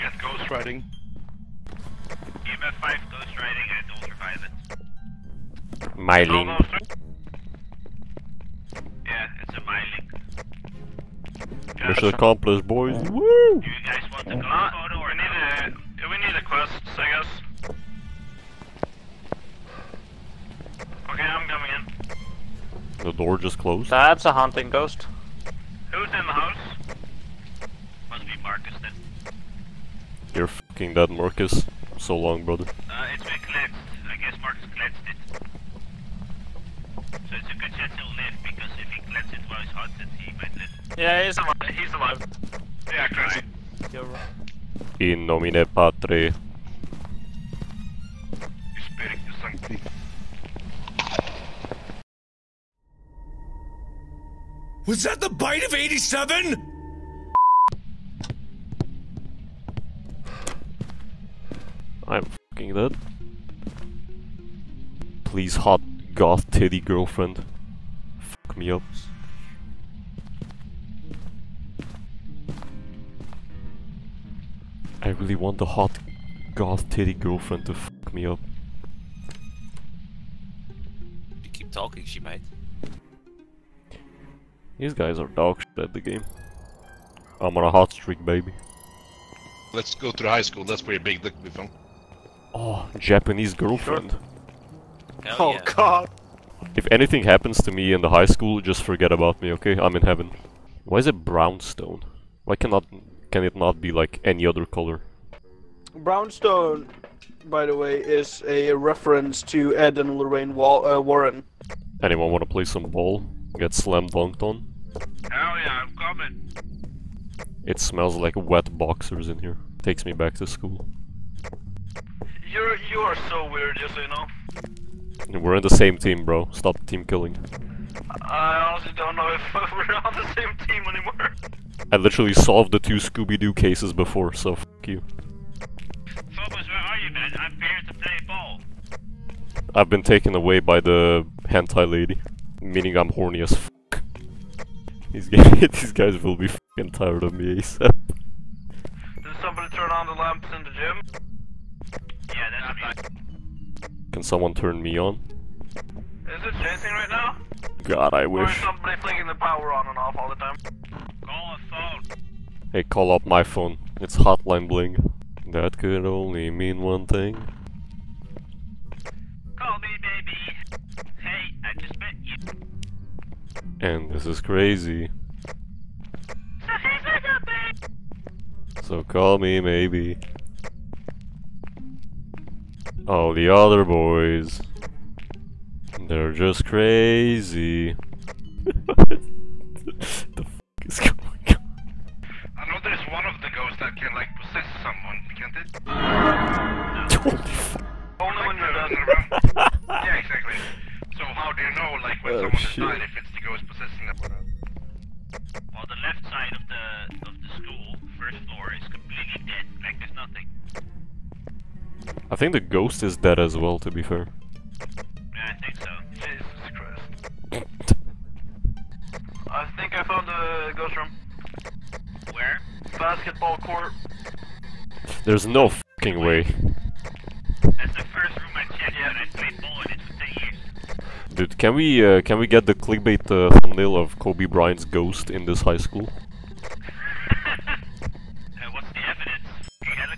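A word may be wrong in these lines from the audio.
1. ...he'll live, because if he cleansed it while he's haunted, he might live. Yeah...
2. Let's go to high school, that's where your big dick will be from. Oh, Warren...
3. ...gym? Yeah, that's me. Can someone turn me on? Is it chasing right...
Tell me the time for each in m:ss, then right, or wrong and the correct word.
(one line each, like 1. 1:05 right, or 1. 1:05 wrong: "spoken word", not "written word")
1. 0:37 right
2. 1:29 wrong: "Japanese", not "Warren"
3. 2:30 right.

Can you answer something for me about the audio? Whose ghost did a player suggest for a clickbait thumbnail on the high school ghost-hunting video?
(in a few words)
Kobe Bryant.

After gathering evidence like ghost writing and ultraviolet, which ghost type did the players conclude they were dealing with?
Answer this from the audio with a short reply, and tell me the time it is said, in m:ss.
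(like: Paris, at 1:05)
Myling, at 0:05.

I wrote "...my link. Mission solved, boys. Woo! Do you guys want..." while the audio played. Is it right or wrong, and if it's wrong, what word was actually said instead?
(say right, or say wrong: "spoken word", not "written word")
wrong: "accomplished", not "solved".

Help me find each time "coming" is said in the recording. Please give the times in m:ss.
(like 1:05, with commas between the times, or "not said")
0:21, 1:55.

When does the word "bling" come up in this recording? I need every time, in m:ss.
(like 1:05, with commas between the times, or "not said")
2:44.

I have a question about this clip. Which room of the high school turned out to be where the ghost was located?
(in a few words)
Basketball court.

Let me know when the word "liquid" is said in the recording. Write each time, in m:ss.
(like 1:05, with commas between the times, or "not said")
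not said.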